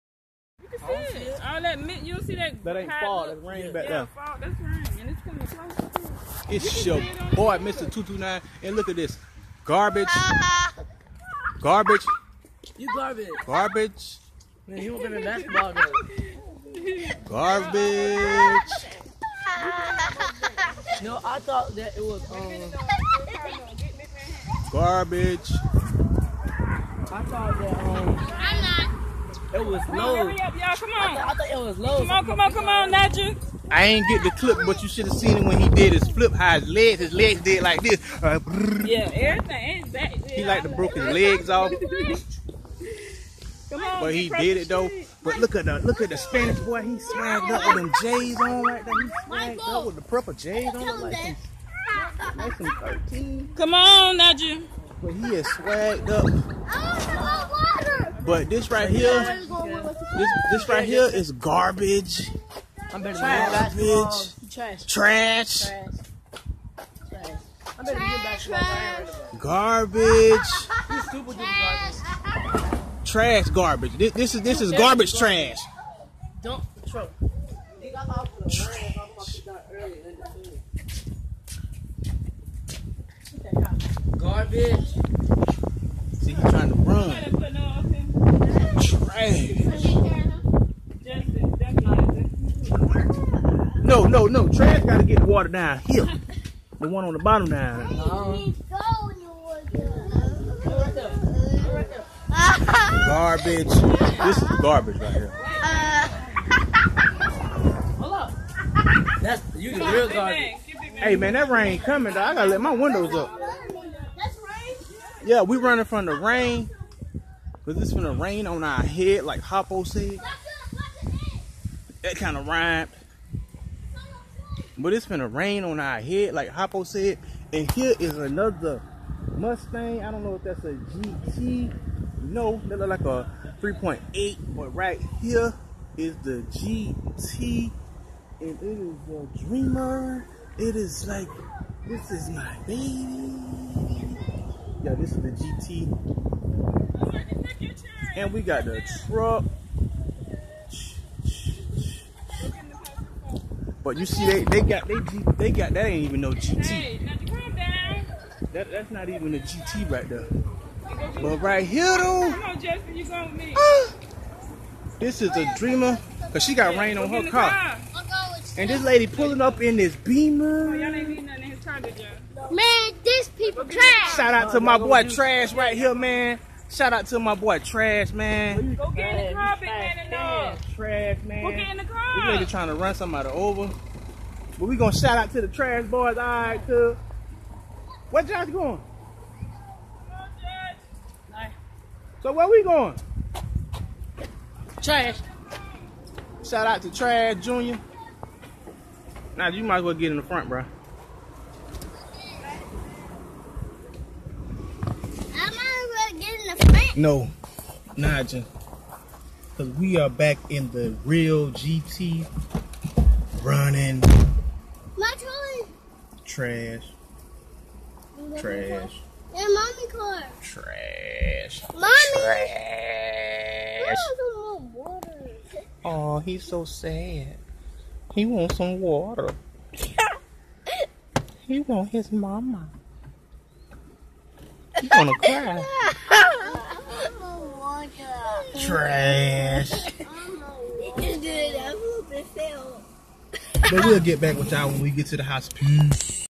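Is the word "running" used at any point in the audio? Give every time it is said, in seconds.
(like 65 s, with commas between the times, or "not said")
115 s, 213 s.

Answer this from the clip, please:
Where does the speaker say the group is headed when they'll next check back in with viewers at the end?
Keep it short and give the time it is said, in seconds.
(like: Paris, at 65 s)
the hospital, at 245 s.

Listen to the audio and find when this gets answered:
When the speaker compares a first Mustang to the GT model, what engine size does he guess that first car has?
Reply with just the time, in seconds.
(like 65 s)
133 s.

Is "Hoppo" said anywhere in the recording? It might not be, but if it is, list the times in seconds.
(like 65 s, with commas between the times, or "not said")
119 s, 126 s.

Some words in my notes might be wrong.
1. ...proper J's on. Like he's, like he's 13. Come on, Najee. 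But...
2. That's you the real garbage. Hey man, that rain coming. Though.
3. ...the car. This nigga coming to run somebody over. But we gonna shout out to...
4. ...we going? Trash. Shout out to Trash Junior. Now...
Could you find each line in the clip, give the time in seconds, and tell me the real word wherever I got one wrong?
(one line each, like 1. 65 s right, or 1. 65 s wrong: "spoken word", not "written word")
1. 50 s right
2. 109 s right
3. 181 s wrong: "trying", not "coming"
4. 192 s right.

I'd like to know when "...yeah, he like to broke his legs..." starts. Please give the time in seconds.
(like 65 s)
40 s.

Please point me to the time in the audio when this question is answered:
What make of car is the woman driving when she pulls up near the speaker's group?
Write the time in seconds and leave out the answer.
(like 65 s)
169 s.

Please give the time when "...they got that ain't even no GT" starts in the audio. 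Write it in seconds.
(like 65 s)
155 s.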